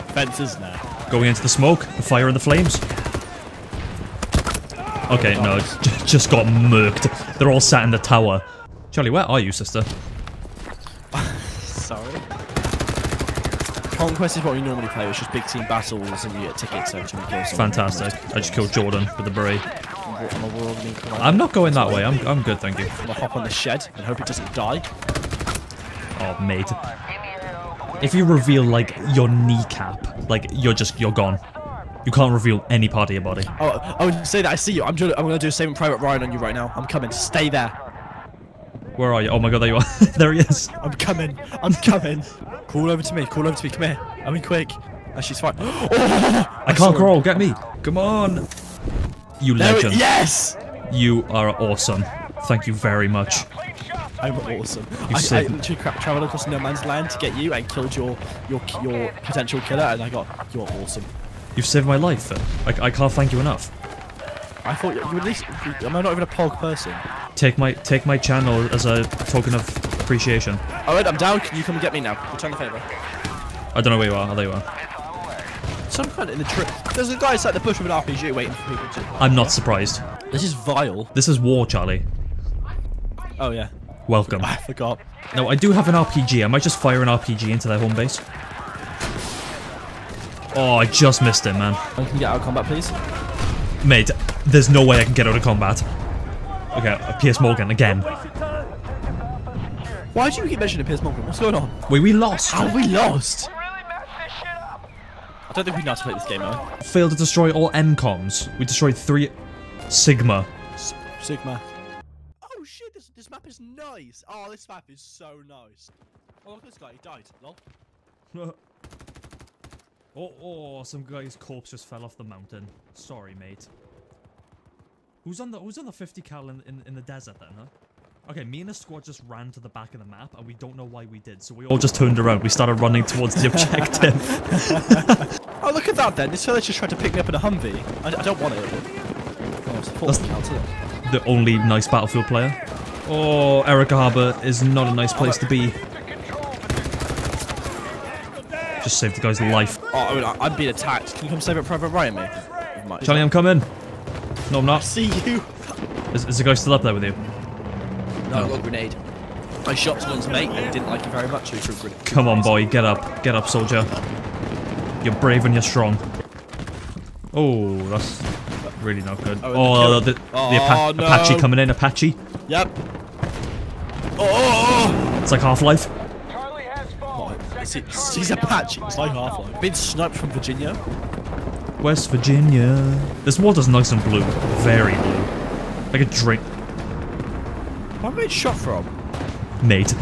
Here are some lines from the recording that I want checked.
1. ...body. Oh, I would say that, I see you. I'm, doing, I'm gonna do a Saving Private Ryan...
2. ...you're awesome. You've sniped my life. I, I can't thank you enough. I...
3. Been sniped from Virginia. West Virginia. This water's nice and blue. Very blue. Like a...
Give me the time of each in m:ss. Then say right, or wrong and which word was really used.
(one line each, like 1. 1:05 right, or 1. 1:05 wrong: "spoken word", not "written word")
1. 0:33 right
2. 1:00 wrong: "saved", not "sniped"
3. 2:59 right.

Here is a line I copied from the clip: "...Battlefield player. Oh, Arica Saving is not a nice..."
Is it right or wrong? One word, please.
wrong.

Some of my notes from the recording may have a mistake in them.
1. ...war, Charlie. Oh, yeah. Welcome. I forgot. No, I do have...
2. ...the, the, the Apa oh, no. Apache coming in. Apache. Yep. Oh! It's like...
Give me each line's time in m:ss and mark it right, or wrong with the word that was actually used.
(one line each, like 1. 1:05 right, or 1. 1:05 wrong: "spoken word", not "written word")
1. 1:21 right
2. 2:49 right.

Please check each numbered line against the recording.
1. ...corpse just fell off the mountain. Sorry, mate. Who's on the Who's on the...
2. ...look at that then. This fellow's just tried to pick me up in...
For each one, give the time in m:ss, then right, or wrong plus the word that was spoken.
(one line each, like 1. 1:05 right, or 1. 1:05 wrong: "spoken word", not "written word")
1. 2:01 right
2. 2:15 right.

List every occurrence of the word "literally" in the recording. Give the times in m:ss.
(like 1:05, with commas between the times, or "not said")
0:55.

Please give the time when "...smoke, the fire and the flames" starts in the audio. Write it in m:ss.
0:01.